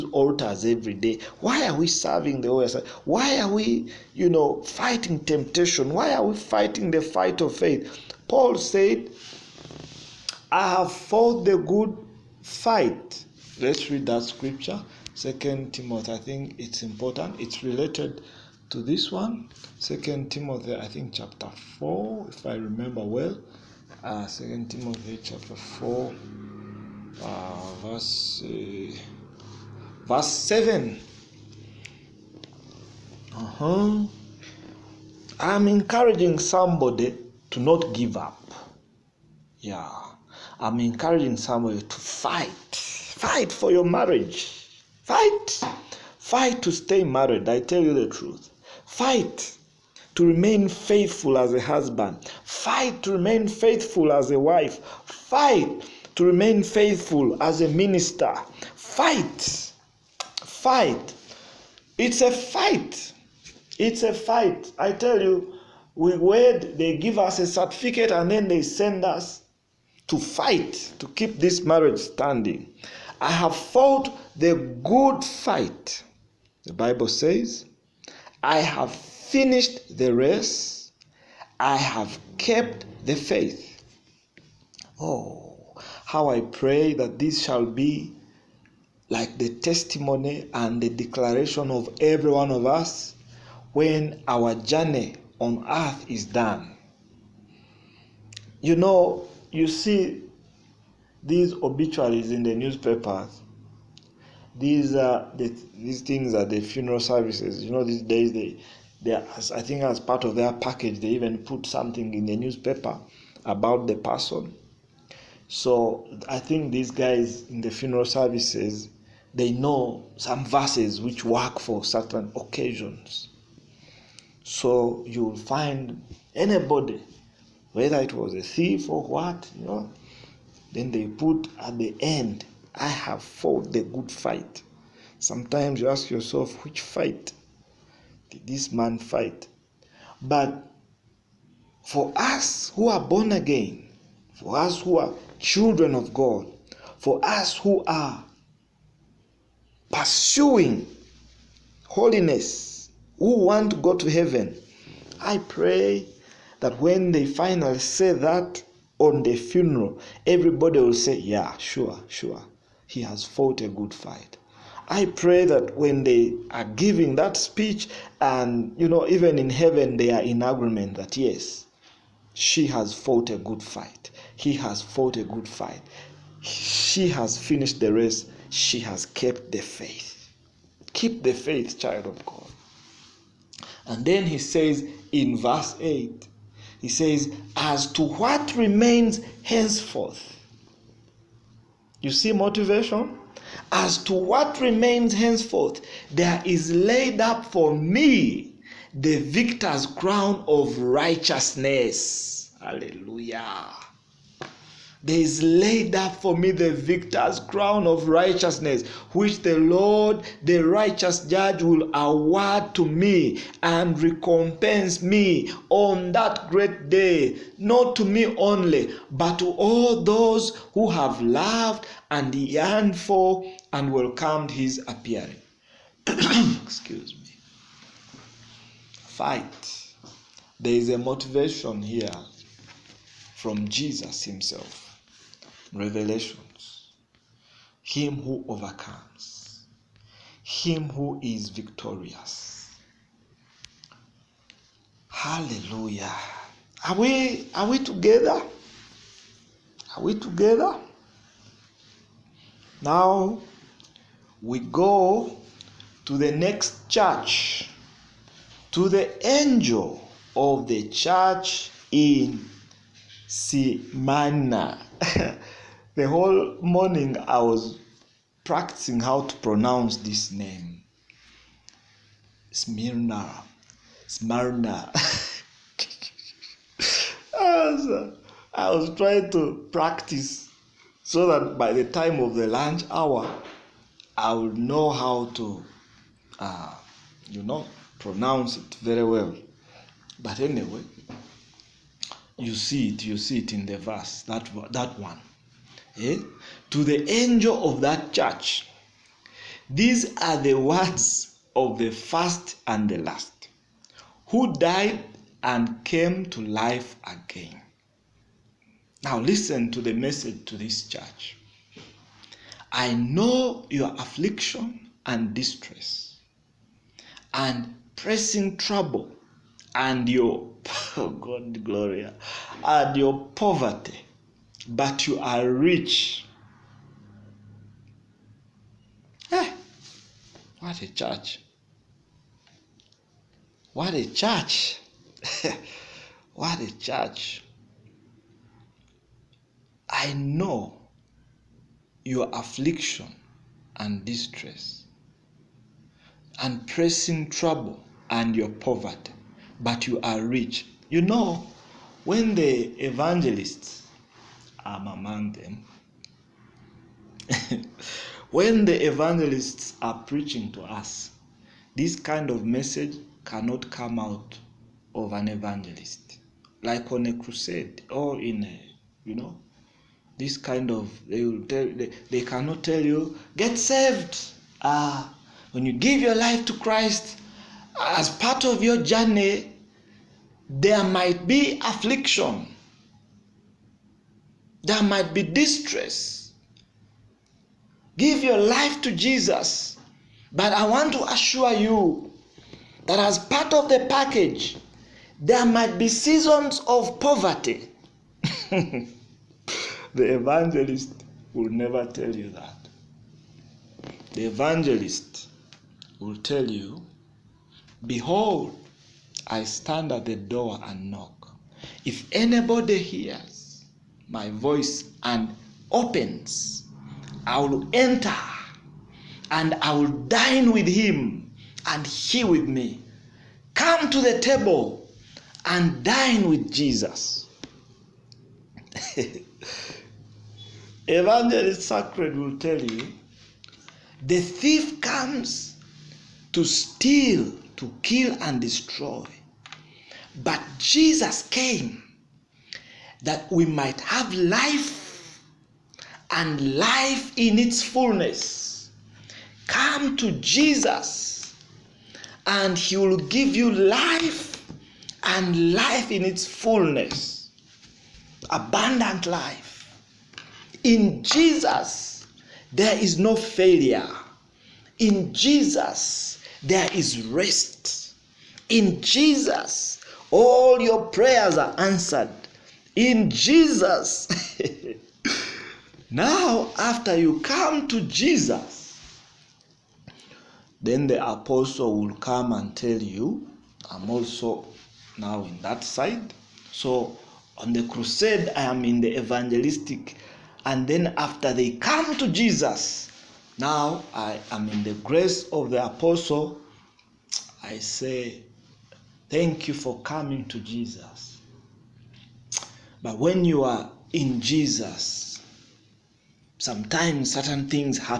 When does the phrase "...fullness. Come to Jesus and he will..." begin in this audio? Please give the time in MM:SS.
07:27.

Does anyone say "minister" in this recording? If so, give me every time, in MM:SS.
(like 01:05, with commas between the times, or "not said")
00:57.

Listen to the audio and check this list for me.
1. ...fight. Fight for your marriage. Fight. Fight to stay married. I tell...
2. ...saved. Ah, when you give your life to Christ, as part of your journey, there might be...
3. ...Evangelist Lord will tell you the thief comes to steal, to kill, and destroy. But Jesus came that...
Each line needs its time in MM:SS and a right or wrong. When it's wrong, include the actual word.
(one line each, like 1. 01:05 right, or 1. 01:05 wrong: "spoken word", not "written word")
1. 00:41 right
2. 06:13 right
3. 07:10 wrong: "Sacred", not "Lord".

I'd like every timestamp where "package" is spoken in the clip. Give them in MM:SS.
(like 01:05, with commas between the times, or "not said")
01:50, 06:33.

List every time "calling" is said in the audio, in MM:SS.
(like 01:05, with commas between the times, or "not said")
not said.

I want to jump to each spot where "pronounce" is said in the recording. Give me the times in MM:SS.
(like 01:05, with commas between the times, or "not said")
04:29, 04:47.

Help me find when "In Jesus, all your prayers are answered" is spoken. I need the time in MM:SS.
07:48.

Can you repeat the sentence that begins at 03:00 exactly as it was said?
Keep the faith, child of God.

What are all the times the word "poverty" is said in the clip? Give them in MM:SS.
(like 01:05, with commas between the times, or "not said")
05:23, 05:48, 06:36.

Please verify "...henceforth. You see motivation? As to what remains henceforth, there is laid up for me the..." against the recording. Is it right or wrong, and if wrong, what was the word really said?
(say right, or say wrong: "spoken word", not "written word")
right.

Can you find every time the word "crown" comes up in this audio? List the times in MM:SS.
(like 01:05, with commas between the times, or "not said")
03:19, 03:27.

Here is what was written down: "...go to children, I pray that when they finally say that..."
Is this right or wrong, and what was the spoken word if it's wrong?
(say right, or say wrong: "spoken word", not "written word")
wrong: "heaven", not "children".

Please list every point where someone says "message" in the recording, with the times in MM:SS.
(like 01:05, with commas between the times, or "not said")
05:09, 06:02.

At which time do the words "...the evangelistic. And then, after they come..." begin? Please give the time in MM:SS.
08:08.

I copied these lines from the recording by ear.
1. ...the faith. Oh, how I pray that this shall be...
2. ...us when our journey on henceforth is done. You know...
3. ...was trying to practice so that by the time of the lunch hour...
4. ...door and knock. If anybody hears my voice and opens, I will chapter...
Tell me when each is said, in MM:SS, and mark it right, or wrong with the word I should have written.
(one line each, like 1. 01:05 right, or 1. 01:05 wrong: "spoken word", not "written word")
1. 01:23 right
2. 01:32 wrong: "earth", not "henceforth"
3. 04:38 right
4. 06:50 wrong: "enter", not "chapter".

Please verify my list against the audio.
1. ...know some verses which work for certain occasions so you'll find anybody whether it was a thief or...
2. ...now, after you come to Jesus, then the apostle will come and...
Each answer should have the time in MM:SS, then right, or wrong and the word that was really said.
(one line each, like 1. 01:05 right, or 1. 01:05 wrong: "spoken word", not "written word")
1. 01:59 right
2. 07:55 right.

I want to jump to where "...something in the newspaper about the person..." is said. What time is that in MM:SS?
01:51.